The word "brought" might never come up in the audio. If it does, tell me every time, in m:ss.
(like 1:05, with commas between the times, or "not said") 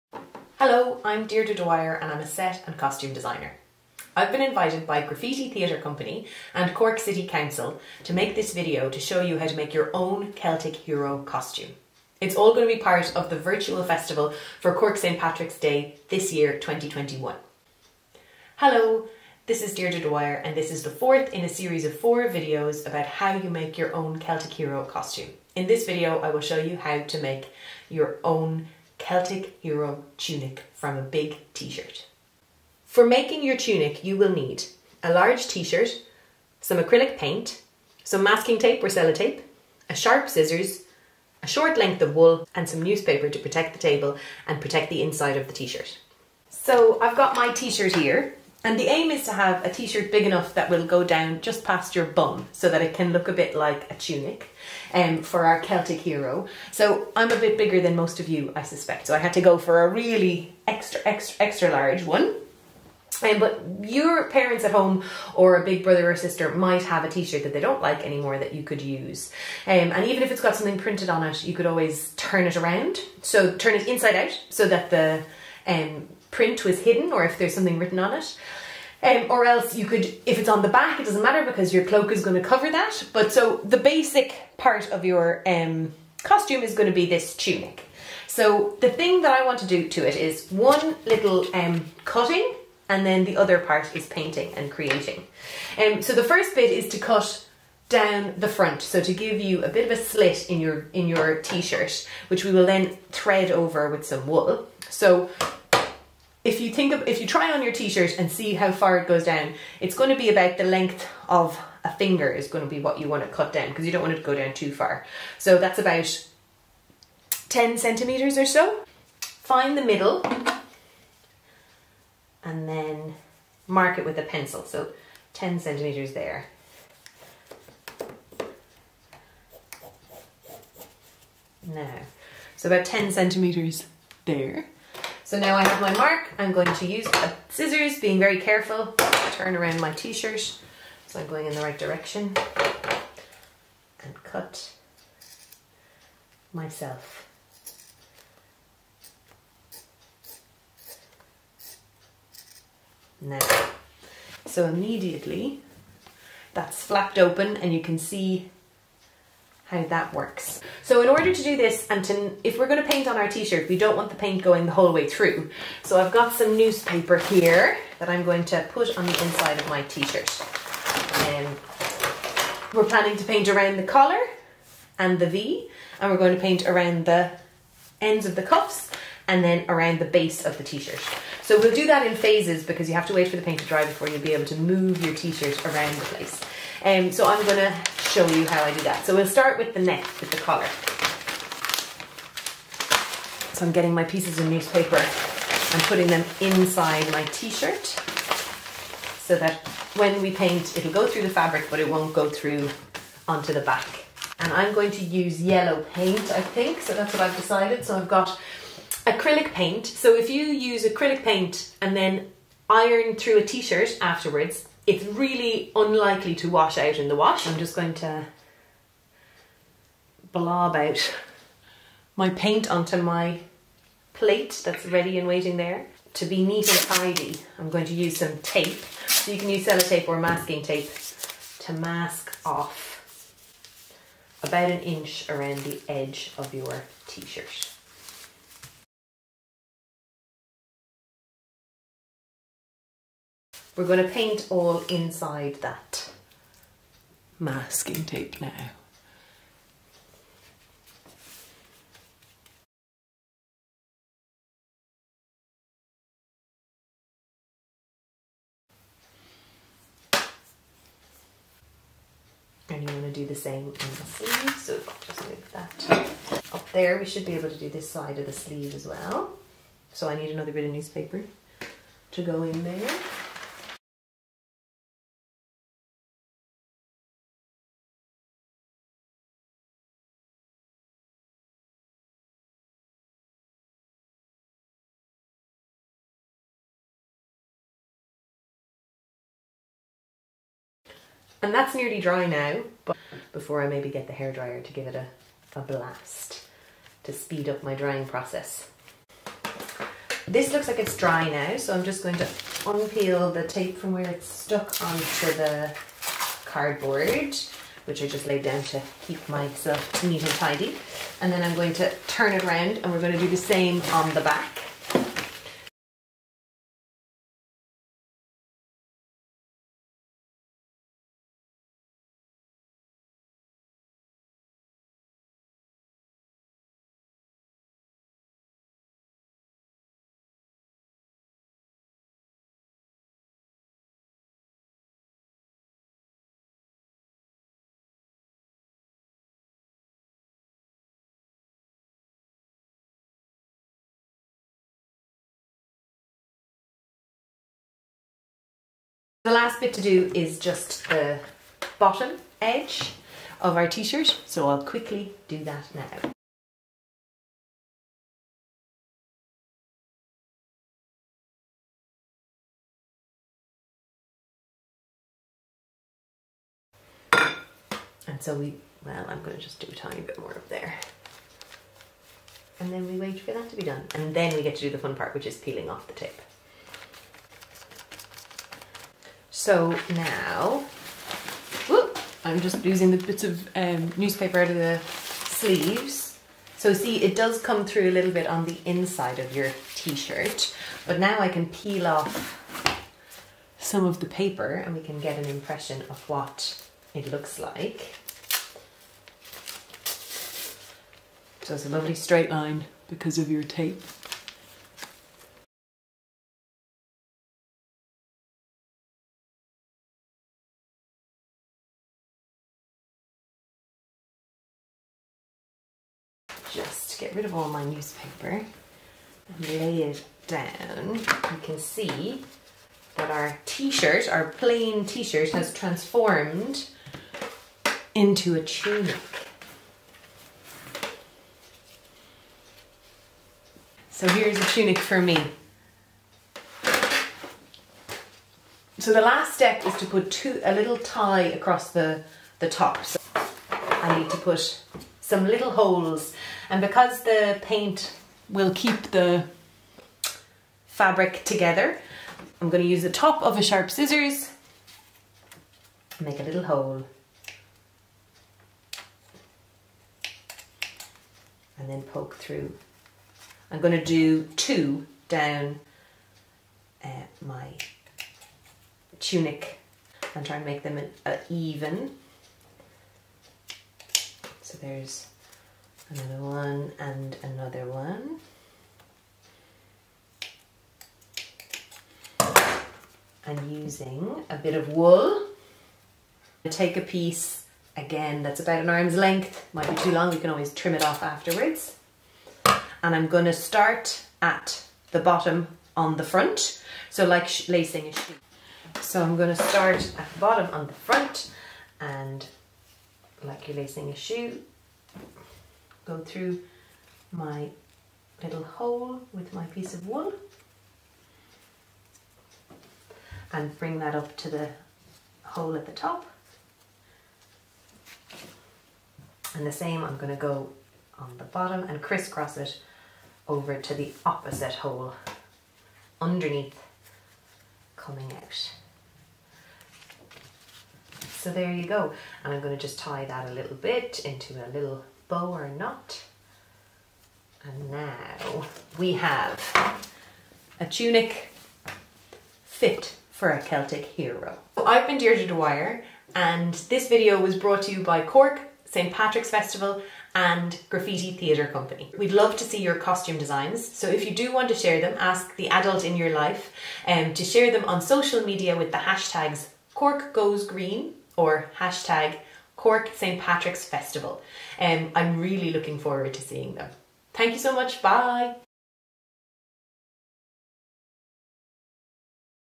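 9:07.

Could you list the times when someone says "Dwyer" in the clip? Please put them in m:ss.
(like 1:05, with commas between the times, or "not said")
0:01, 0:20, 9:05.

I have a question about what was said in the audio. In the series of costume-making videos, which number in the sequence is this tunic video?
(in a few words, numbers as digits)
fourth.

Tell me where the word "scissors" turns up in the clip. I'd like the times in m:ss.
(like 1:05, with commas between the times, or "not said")
0:40, 2:17, 7:33.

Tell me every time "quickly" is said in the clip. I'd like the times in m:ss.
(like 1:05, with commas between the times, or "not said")
5:54.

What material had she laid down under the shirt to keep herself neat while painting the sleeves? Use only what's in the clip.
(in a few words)
cardboard.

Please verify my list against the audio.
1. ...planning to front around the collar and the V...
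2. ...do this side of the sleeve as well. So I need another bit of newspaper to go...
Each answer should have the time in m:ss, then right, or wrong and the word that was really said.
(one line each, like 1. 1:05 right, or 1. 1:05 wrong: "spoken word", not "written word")
1. 2:52 wrong: "paint", not "front"
2. 4:27 right.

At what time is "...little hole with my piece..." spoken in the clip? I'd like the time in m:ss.
8:28.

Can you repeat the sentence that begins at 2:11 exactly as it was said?
Now, so about 10 centimeters there.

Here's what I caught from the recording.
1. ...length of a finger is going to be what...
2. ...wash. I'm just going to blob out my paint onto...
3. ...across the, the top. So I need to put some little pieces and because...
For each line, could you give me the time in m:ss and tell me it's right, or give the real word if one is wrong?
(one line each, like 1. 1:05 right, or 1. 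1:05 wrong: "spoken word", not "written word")
1. 1:50 right
2. 3:37 right
3. 7:21 wrong: "holes", not "pieces".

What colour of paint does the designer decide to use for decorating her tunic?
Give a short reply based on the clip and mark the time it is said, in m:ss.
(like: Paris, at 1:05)
yellow, at 3:25.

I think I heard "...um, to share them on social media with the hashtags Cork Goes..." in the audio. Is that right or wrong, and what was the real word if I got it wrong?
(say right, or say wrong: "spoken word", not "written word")
right.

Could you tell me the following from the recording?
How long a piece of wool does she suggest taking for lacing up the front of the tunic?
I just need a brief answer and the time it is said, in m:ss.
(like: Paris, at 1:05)
an arm's length, at 8:08.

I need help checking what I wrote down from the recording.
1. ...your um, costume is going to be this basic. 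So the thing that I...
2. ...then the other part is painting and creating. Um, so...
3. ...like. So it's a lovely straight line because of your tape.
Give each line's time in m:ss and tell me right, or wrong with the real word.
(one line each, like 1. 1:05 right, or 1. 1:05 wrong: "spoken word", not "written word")
1. 1:25 wrong: "tunic", not "basic"
2. 1:33 right
3. 6:37 right.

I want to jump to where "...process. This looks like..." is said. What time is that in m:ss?
4:58.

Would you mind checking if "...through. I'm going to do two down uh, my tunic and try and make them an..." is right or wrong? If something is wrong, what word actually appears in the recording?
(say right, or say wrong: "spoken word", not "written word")
right.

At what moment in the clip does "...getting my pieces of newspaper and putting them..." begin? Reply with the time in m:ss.
3:13.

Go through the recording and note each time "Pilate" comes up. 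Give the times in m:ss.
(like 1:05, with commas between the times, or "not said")
not said.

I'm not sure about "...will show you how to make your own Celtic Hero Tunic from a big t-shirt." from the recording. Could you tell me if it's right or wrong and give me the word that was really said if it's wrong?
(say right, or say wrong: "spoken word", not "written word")
right.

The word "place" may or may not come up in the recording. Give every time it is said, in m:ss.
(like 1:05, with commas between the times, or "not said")
3:06.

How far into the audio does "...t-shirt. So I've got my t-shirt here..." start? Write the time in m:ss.
0:45.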